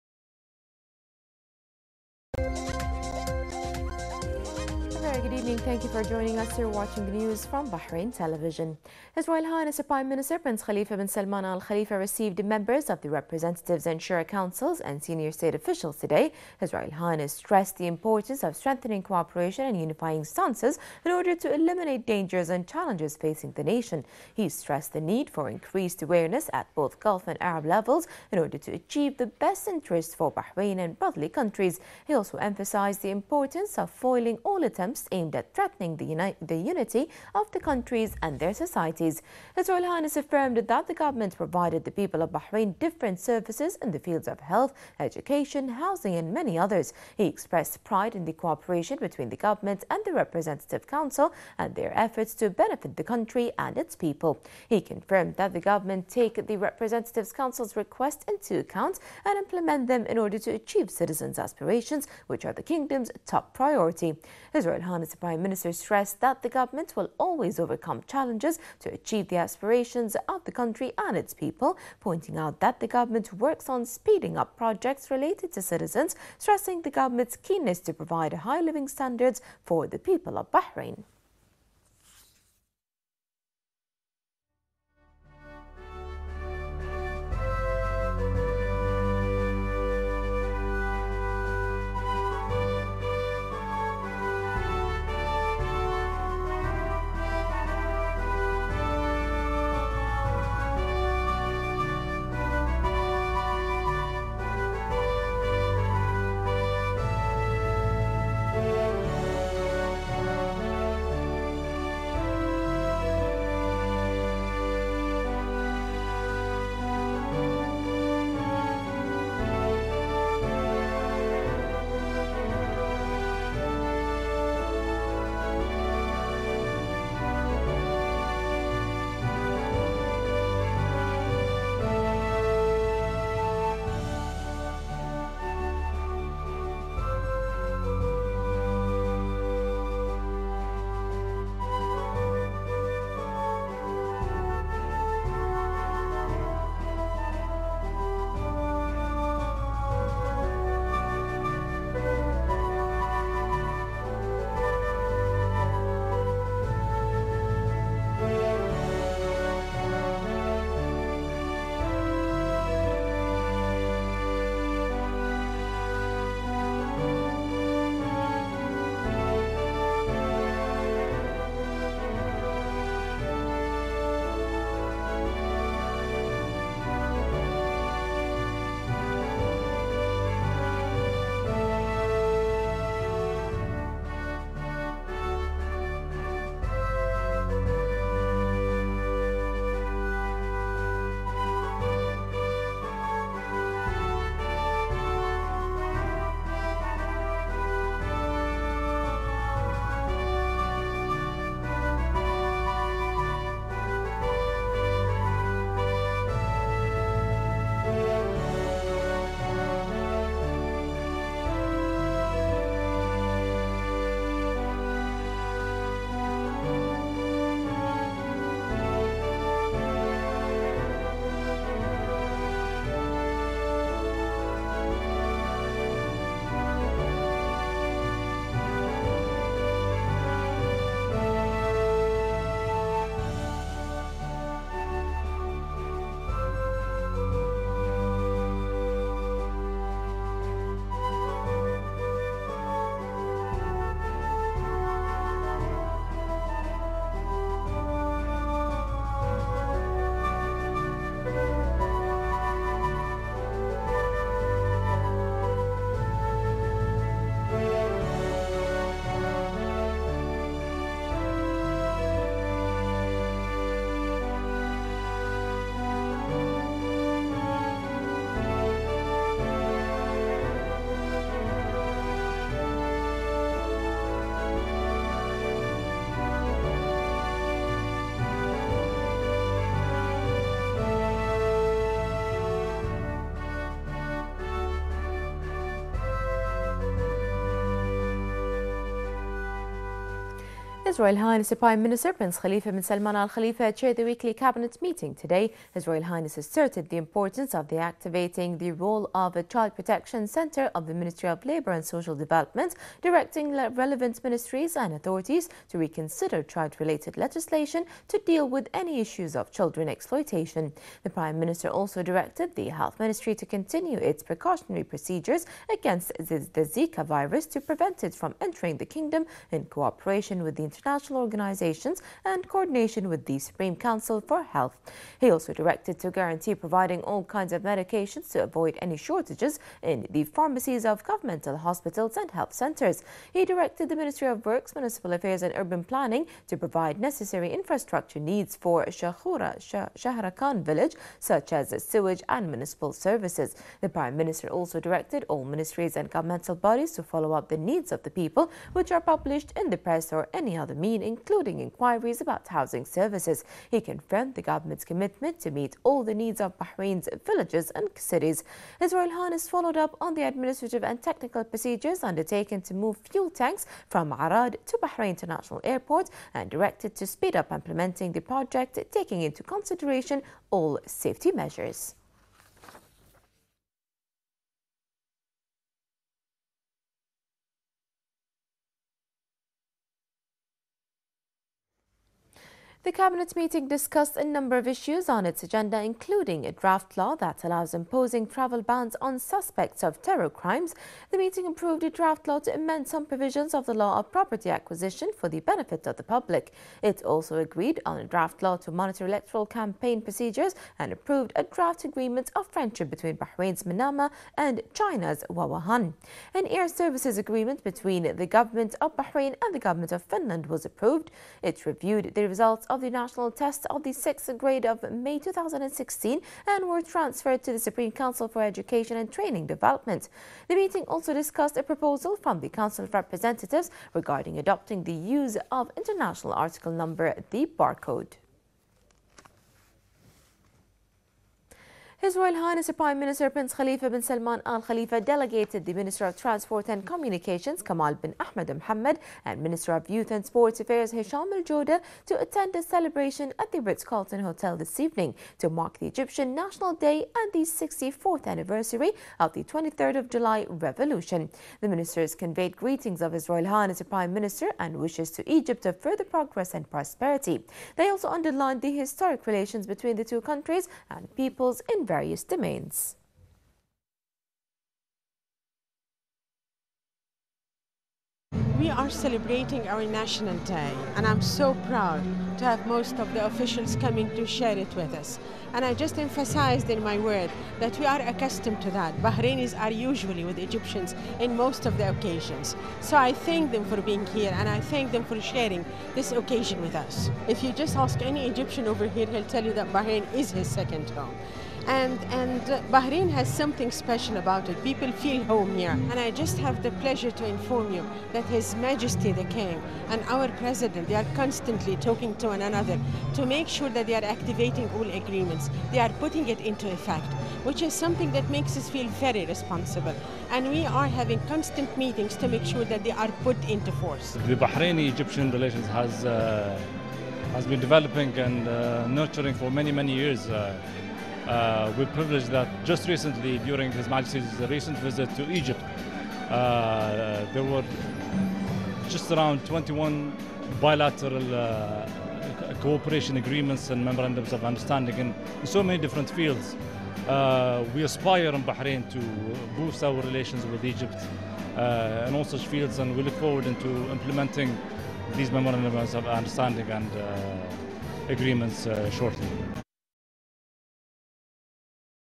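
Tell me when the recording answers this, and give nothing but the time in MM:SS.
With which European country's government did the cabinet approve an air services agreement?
06:50.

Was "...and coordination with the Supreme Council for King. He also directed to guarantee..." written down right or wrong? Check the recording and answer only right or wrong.
wrong.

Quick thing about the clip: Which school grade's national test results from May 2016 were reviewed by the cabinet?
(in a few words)
Sixth grade.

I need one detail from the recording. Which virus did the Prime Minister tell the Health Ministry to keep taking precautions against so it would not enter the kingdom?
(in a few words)
Zika.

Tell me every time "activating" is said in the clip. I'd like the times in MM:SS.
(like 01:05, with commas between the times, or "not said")
04:57, 08:24.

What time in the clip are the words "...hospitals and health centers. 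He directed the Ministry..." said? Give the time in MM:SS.
05:31.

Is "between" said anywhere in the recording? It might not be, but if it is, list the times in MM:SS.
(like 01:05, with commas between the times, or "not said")
00:48, 06:42, 06:47, 07:39.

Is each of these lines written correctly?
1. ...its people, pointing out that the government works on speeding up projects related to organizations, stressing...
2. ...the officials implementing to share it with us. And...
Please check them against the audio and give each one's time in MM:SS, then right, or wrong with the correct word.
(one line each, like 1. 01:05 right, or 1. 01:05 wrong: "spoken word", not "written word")
1. 01:11 wrong: "citizens", not "organizations"
2. 07:53 wrong: "coming", not "implementing".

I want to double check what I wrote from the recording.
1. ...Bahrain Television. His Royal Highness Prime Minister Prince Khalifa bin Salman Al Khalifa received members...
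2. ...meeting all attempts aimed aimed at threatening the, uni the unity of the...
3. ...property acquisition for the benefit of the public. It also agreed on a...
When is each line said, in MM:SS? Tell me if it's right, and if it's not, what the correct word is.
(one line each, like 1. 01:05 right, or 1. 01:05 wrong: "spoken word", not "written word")
1. 00:07 right
2. 00:33 wrong: "foiling", not "meeting"
3. 06:34 right.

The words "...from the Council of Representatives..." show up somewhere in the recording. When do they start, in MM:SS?
07:02.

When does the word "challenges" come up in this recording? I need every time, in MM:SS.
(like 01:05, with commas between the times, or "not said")
00:22, 01:08.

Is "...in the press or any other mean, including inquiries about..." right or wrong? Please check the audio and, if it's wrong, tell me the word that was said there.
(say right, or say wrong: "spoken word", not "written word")
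right.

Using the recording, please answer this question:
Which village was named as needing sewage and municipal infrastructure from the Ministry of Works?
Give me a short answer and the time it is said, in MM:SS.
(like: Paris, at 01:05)
Shakhura Shahrakan, at 05:38.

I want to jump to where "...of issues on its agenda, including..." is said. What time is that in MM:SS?
06:24.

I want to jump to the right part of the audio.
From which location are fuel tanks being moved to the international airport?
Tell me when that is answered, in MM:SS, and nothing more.
06:04.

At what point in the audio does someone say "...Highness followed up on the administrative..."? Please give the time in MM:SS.
05:59.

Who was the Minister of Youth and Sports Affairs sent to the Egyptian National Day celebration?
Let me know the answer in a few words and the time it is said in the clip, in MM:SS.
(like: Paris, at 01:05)
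Hisham Al Jowder, at 07:20.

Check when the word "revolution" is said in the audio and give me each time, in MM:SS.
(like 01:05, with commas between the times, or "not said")
07:30.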